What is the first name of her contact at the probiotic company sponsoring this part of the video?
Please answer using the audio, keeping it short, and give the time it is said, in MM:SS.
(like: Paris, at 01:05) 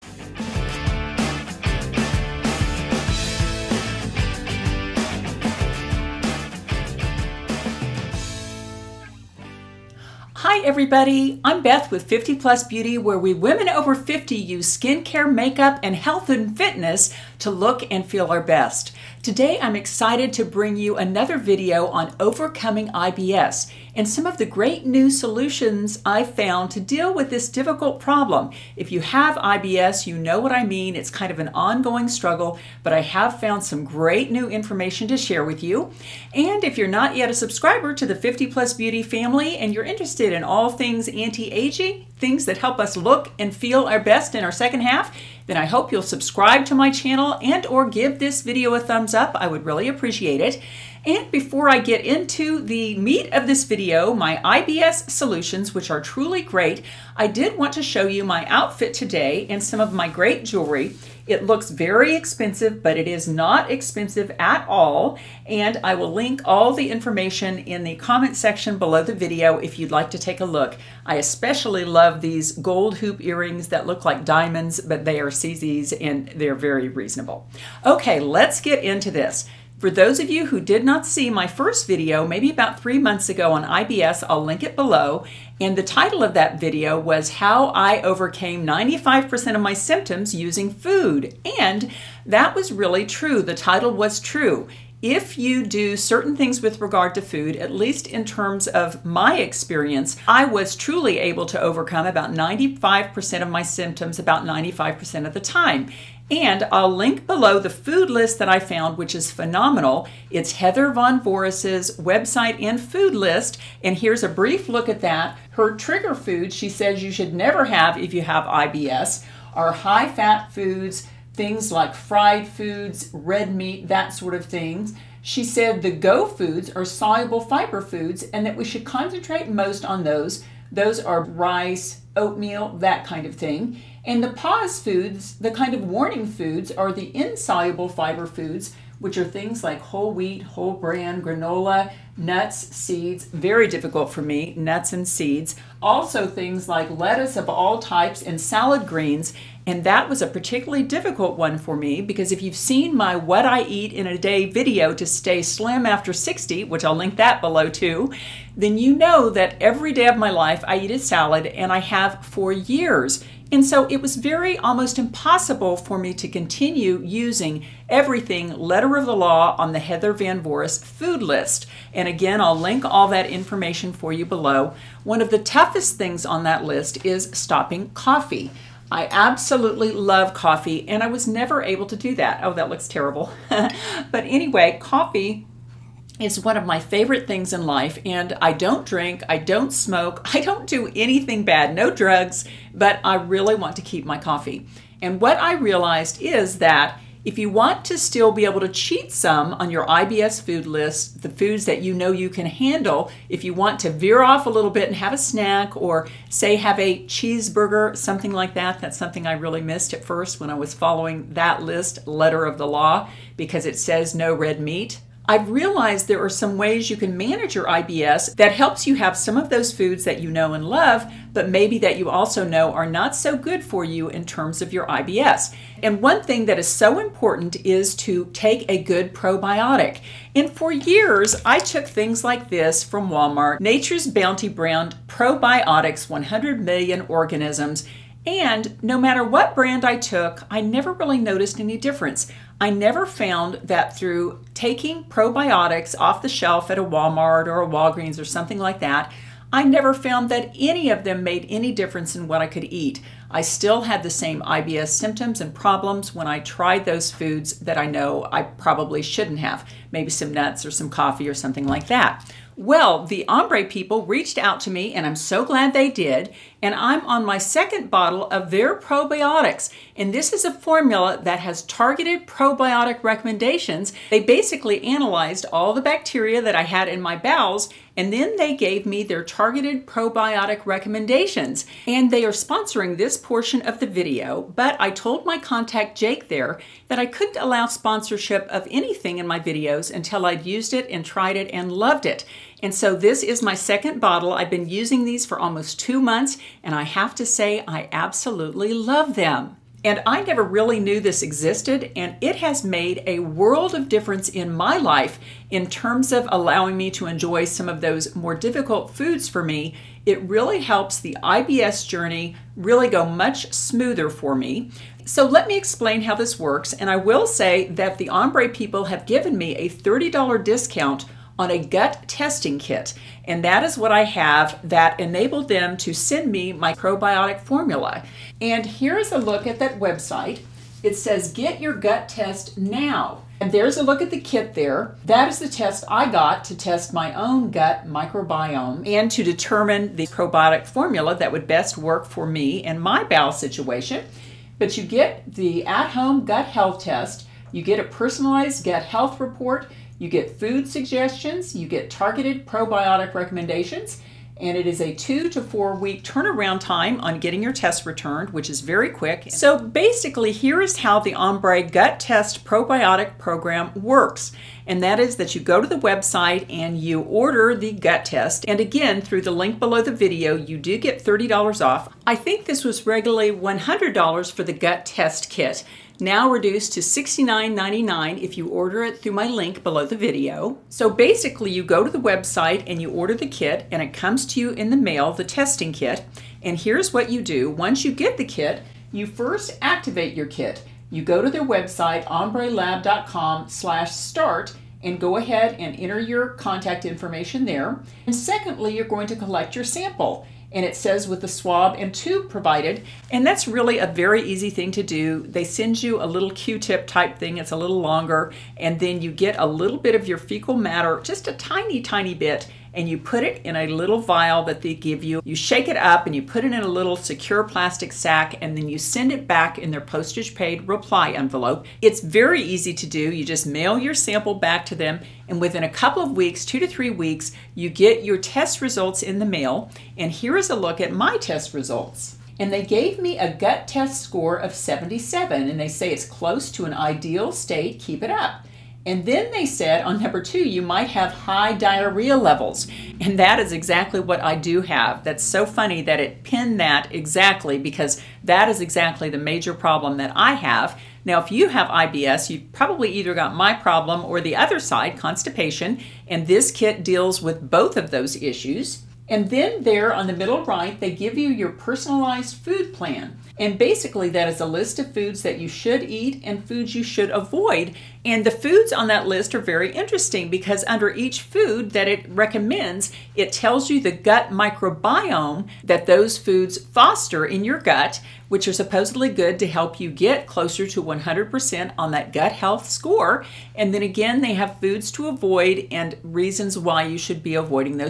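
Jake, at 04:45.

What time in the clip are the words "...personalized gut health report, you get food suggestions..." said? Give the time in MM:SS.
05:47.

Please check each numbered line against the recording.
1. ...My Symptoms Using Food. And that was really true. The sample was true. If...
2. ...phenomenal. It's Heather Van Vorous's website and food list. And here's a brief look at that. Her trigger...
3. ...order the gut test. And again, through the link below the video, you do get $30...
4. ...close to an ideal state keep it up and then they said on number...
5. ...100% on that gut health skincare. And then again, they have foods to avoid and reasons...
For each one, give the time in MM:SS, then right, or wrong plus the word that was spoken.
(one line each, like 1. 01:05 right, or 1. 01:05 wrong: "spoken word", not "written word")
1. 01:29 wrong: "title", not "sample"
2. 01:49 right
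3. 06:07 right
4. 07:16 right
5. 08:00 wrong: "score", not "skincare".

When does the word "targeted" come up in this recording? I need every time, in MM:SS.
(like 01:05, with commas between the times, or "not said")
04:31, 04:39, 05:51.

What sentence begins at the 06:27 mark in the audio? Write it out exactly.
Once you get the kit, you first activate your kit.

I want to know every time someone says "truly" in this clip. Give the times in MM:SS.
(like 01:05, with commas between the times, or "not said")
00:56, 01:40.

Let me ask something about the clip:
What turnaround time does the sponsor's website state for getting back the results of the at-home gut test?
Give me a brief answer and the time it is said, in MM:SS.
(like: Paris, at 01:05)
2 to 4 weeks, at 05:54.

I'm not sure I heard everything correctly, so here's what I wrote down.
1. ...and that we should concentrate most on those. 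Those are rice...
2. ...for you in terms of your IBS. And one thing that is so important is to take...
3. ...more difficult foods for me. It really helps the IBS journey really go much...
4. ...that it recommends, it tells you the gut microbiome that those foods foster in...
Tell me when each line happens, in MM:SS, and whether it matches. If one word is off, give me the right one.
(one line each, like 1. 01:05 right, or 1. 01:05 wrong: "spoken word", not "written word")
1. 02:08 right
2. 03:43 right
3. 05:08 right
4. 07:51 right.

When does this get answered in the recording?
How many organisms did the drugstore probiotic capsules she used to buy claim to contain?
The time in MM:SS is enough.
03:56.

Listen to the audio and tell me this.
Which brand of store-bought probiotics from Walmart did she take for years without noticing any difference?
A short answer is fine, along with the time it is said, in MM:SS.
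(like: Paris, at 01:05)
Nature's Bounty, at 03:53.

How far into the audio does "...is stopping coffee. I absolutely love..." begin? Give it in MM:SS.
02:57.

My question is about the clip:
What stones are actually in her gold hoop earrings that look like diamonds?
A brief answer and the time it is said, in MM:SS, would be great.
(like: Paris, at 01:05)
CZs, at 01:15.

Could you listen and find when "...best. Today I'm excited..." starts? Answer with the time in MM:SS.
00:18.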